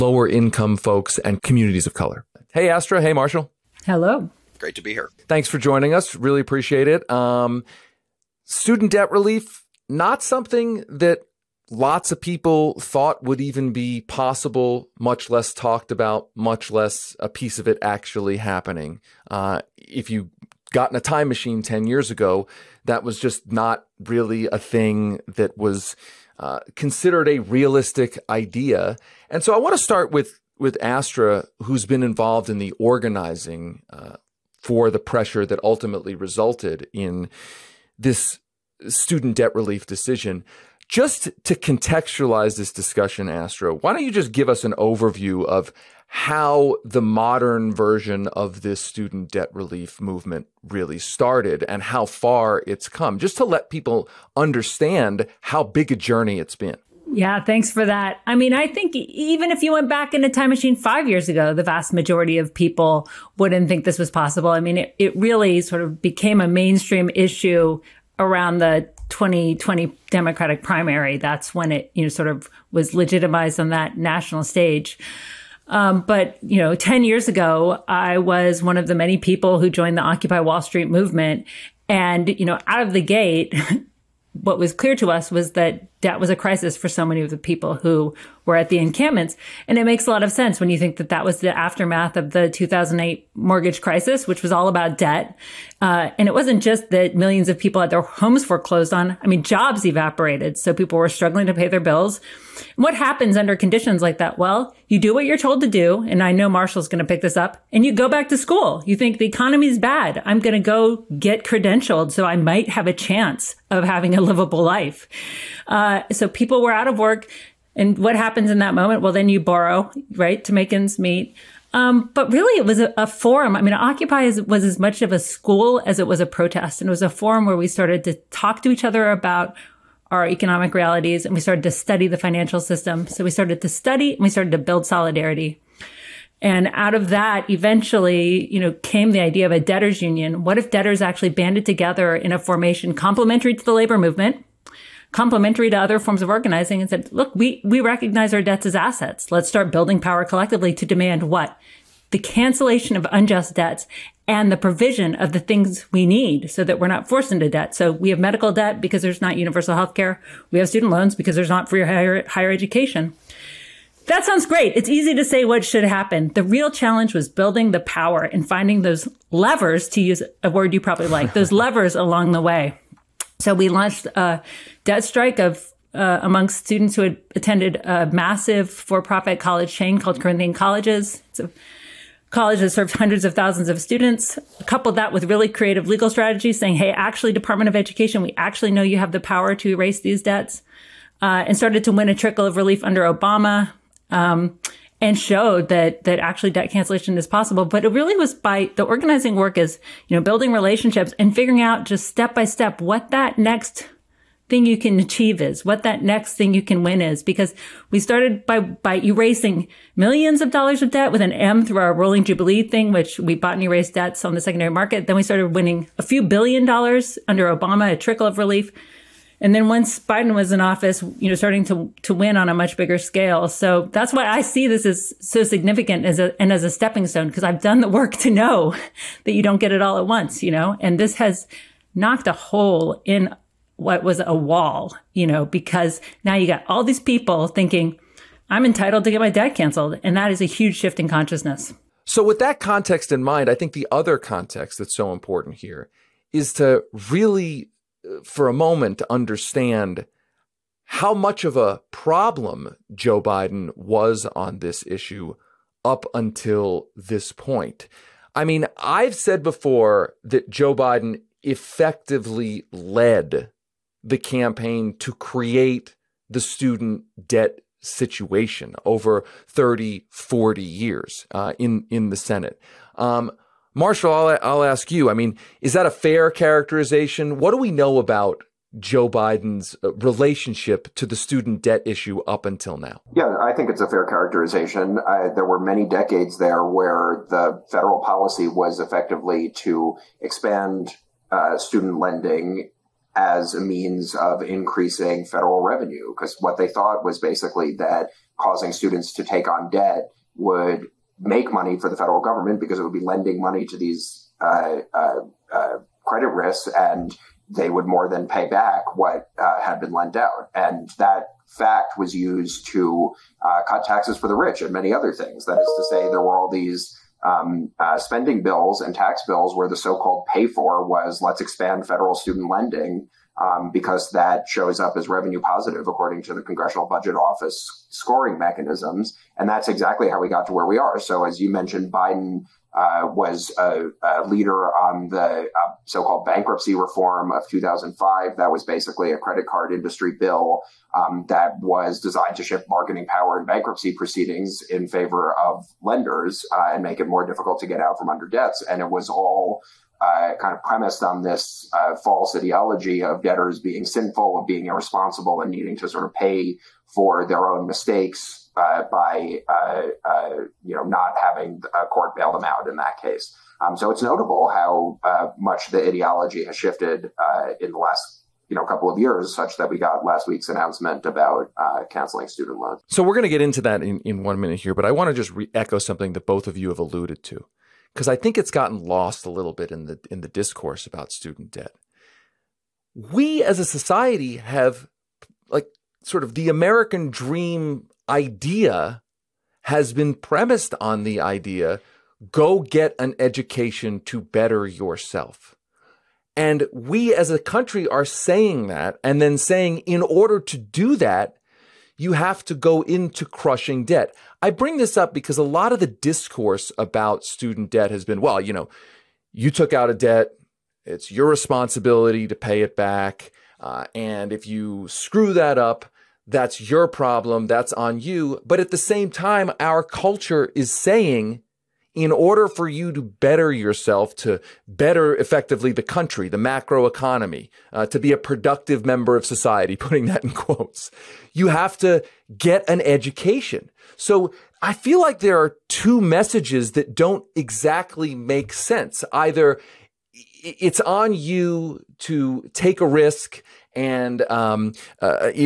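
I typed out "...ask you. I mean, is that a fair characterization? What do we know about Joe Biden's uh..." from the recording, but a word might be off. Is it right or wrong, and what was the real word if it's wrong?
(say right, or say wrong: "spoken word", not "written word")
right.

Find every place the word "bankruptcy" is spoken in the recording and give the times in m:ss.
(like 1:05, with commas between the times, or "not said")
5:36, 5:43.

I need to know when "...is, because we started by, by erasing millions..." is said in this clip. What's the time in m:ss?
3:27.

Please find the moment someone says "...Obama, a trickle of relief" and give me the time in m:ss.
3:37.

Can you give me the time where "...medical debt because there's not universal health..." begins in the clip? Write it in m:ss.
2:38.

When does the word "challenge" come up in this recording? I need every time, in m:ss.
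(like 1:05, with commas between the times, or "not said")
2:46.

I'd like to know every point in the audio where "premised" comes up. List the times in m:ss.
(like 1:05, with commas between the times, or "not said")
5:50, 6:30.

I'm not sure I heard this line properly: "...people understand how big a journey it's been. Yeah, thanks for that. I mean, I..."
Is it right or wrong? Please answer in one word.
right.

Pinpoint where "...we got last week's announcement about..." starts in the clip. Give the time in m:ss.
6:09.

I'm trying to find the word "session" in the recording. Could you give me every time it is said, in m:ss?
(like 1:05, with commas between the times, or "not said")
not said.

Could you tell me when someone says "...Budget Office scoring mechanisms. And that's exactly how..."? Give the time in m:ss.
5:26.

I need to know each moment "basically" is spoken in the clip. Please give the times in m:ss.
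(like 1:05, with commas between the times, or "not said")
4:57, 5:38.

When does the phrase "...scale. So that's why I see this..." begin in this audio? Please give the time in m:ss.
3:42.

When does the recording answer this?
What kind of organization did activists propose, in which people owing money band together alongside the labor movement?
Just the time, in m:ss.
2:19.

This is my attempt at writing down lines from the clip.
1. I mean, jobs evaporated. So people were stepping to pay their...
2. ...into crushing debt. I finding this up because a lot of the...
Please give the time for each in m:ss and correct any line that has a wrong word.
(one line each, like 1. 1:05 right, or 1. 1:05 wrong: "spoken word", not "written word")
1. 1:39 wrong: "struggling", not "stepping"
2. 6:42 wrong: "bring", not "finding".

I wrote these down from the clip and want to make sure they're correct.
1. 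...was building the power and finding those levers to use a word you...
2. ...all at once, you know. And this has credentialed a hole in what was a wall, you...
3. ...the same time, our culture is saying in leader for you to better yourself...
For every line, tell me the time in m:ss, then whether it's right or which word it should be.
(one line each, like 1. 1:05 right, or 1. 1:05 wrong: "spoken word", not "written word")
1. 2:47 right
2. 3:49 wrong: "knocked", not "credentialed"
3. 6:58 wrong: "order", not "leader".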